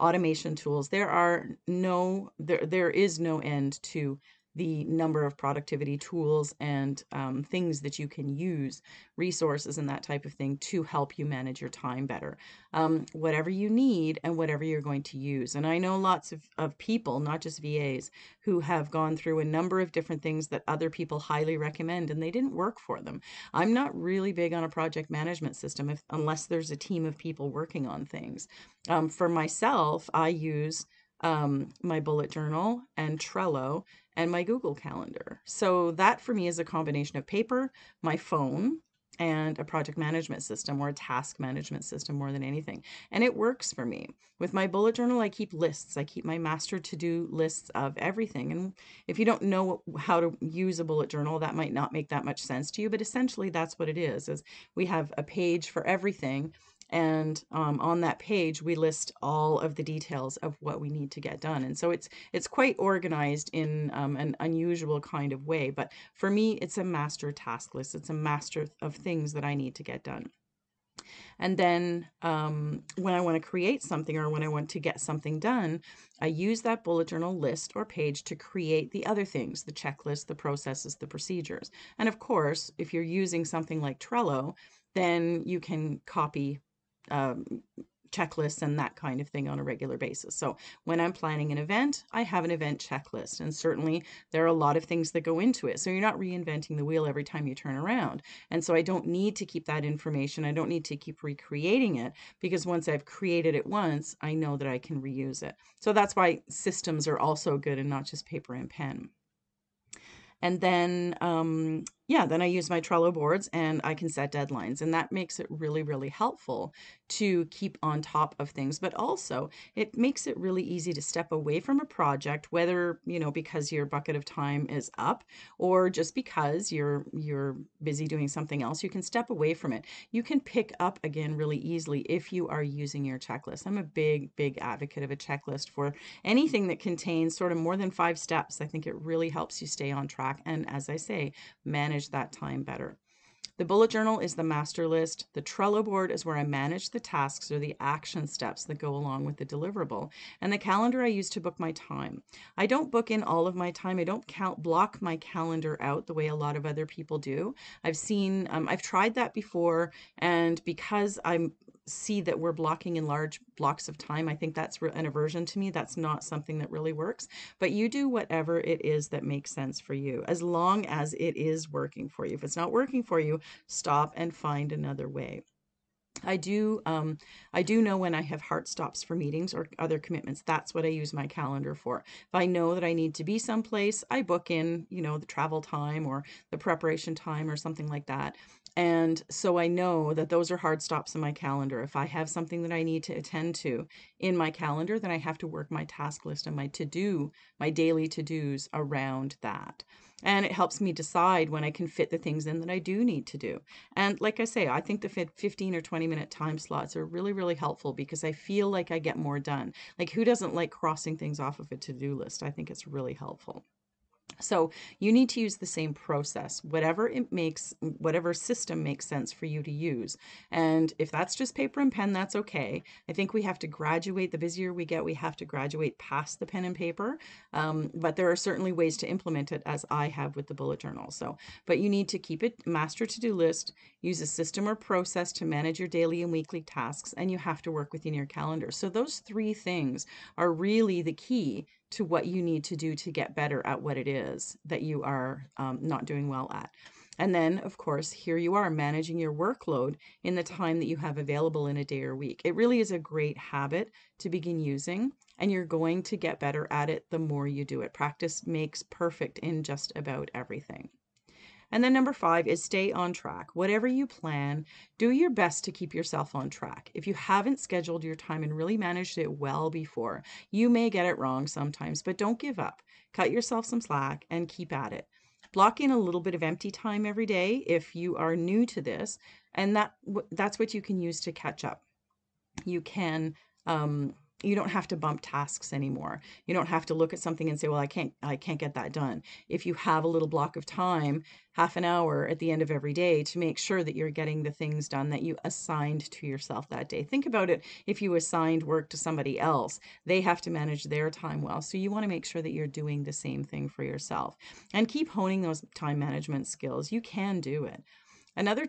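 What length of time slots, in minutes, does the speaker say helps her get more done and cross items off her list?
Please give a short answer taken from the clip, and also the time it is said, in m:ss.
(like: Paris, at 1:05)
15 or 20 minutes, at 3:25.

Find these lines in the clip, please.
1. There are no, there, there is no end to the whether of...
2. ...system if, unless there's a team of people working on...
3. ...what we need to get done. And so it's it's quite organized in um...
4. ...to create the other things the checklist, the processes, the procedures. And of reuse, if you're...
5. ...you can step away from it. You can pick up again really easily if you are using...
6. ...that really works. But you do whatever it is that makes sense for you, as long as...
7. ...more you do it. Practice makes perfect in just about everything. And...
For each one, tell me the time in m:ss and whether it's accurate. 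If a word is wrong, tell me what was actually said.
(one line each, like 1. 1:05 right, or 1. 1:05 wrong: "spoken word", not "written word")
1. 0:00 wrong: "number", not "whether"
2. 0:25 right
3. 1:00 right
4. 1:18 wrong: "course", not "reuse"
5. 2:08 right
6. 2:46 right
7. 4:17 right.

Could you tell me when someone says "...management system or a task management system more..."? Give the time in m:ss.
0:39.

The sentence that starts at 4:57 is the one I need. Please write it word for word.
Think about it, if you assigned work to somebody else, they have to manage their time well.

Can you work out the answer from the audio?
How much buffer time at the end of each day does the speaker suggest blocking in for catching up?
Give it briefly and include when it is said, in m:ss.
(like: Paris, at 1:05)
Half an hour, at 4:51.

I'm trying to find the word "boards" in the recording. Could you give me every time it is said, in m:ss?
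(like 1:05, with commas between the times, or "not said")
1:53, 2:25.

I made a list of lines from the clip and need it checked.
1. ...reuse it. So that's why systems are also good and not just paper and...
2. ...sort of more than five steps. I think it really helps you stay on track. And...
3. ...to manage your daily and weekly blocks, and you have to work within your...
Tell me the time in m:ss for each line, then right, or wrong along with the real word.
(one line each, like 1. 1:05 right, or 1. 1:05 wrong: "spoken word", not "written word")
1. 1:45 right
2. 2:17 right
3. 3:55 wrong: "tasks", not "blocks".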